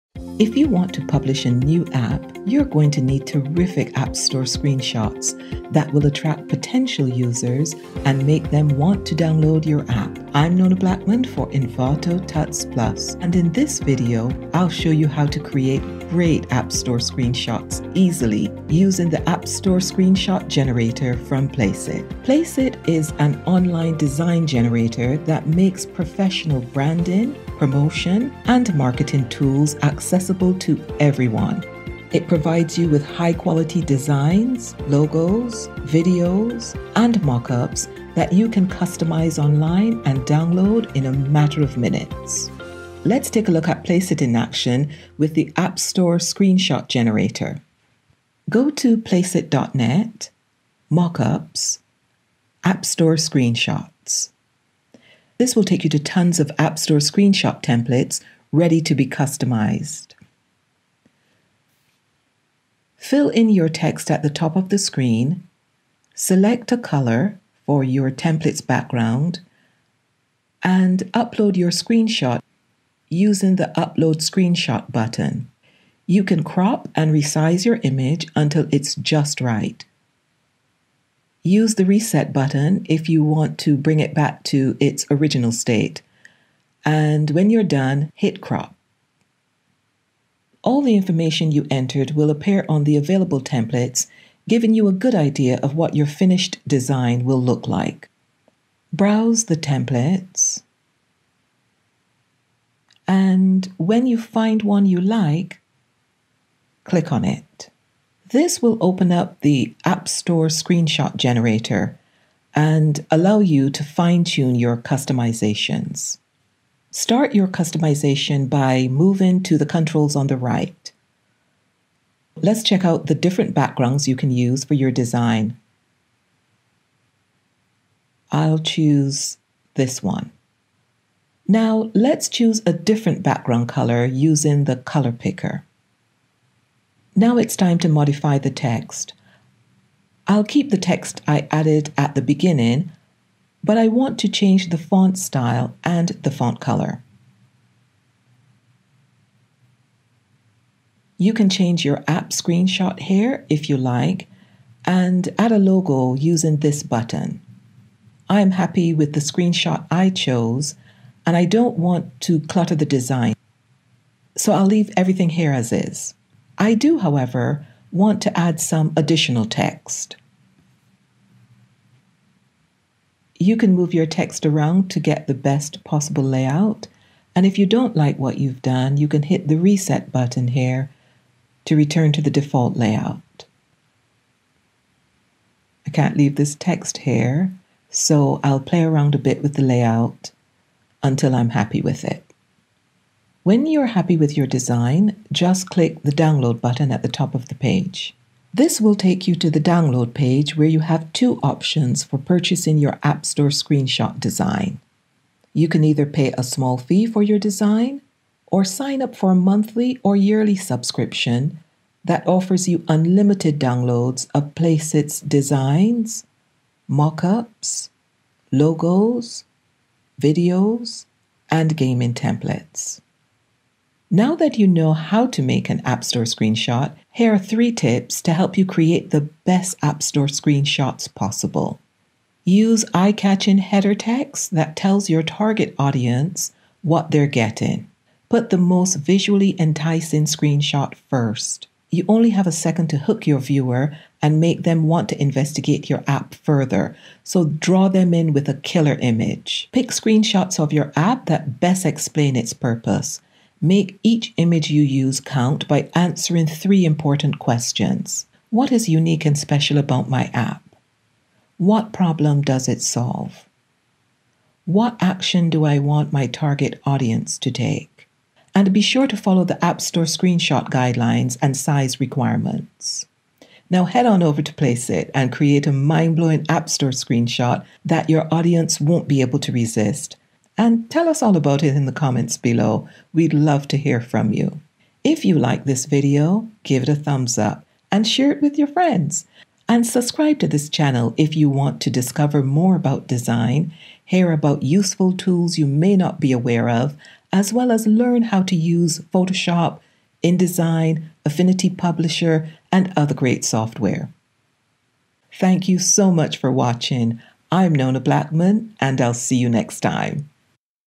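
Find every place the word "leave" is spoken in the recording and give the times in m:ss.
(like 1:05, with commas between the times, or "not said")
2:44, 3:06.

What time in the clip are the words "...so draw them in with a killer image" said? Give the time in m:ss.
4:07.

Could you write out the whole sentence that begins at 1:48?
This will open up the App Store screenshot generator and allow you to fine tune your customizations.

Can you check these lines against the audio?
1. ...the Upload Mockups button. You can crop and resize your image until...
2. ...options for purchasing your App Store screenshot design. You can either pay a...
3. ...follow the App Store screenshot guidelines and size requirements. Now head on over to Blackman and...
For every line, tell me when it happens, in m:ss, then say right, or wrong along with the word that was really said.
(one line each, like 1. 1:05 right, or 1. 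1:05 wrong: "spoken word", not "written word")
1. 1:13 wrong: "Screenshot", not "Mockups"
2. 3:21 right
3. 4:29 wrong: "Placeit", not "Blackman".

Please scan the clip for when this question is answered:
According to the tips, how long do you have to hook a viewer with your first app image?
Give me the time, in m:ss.
4:02.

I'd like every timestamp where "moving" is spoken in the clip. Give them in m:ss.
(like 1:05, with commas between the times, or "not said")
1:58.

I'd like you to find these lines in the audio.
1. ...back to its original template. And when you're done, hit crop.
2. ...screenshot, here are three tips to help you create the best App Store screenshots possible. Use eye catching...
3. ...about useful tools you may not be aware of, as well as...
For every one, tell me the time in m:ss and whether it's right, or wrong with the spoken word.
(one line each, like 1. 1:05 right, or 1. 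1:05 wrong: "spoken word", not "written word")
1. 1:24 wrong: "state", not "template"
2. 3:46 right
3. 4:54 right.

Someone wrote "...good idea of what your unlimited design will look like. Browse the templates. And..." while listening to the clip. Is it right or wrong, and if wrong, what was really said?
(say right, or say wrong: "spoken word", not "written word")
wrong: "finished", not "unlimited".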